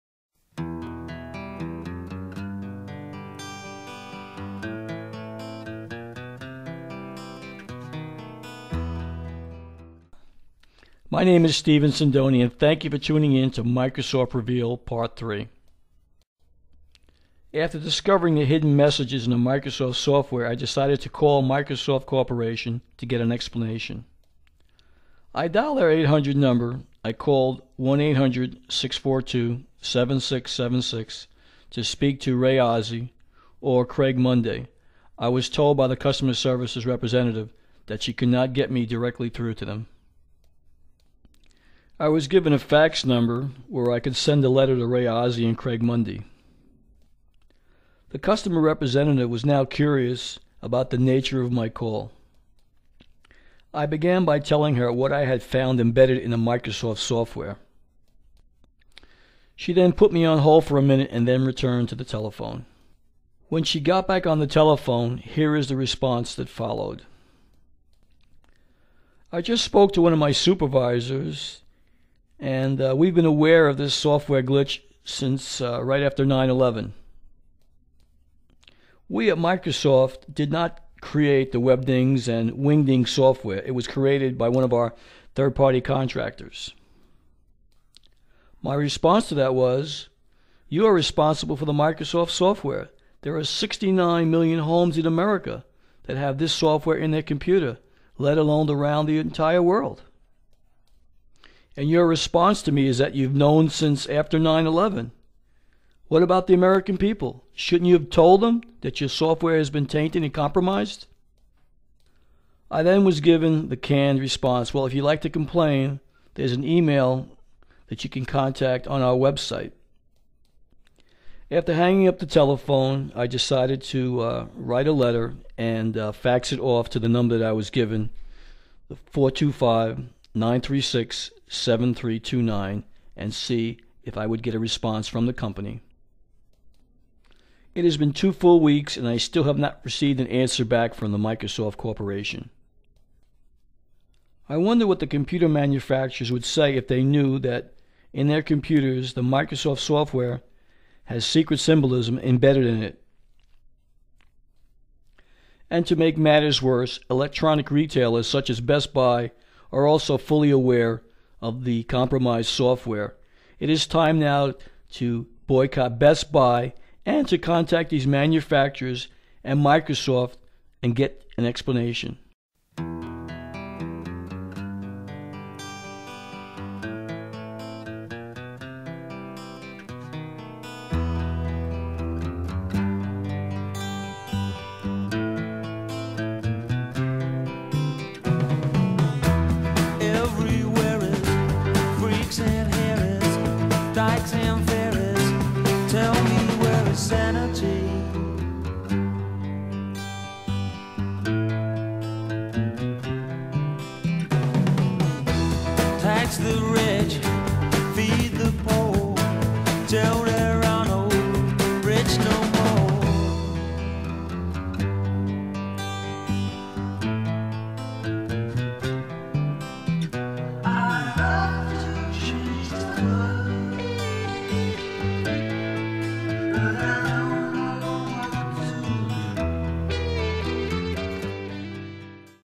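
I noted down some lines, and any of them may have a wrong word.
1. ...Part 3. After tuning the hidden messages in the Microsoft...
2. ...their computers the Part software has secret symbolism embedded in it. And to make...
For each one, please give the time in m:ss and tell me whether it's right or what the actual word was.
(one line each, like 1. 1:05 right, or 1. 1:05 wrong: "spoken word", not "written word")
1. 0:14 wrong: "discovering", not "tuning"
2. 2:28 wrong: "Microsoft", not "Part".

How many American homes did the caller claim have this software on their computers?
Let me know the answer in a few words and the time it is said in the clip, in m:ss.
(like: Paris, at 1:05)
69 million, at 1:33.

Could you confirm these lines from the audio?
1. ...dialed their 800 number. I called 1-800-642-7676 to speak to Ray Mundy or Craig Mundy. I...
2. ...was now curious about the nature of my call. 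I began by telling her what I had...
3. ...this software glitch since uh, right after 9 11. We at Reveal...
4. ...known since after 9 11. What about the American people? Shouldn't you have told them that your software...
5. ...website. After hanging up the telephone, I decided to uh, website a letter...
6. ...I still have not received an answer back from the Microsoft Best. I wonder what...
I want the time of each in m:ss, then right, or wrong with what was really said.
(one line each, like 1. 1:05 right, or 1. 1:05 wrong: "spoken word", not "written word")
1. 0:25 wrong: "Ozzie", not "Mundy"
2. 0:49 right
3. 1:13 wrong: "Microsoft", not "Reveal"
4. 1:43 right
5. 1:59 wrong: "write", not "website"
6. 2:19 wrong: "Corporation", not "Best".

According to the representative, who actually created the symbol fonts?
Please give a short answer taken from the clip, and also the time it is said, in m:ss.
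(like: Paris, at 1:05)
third party contractors, at 1:25.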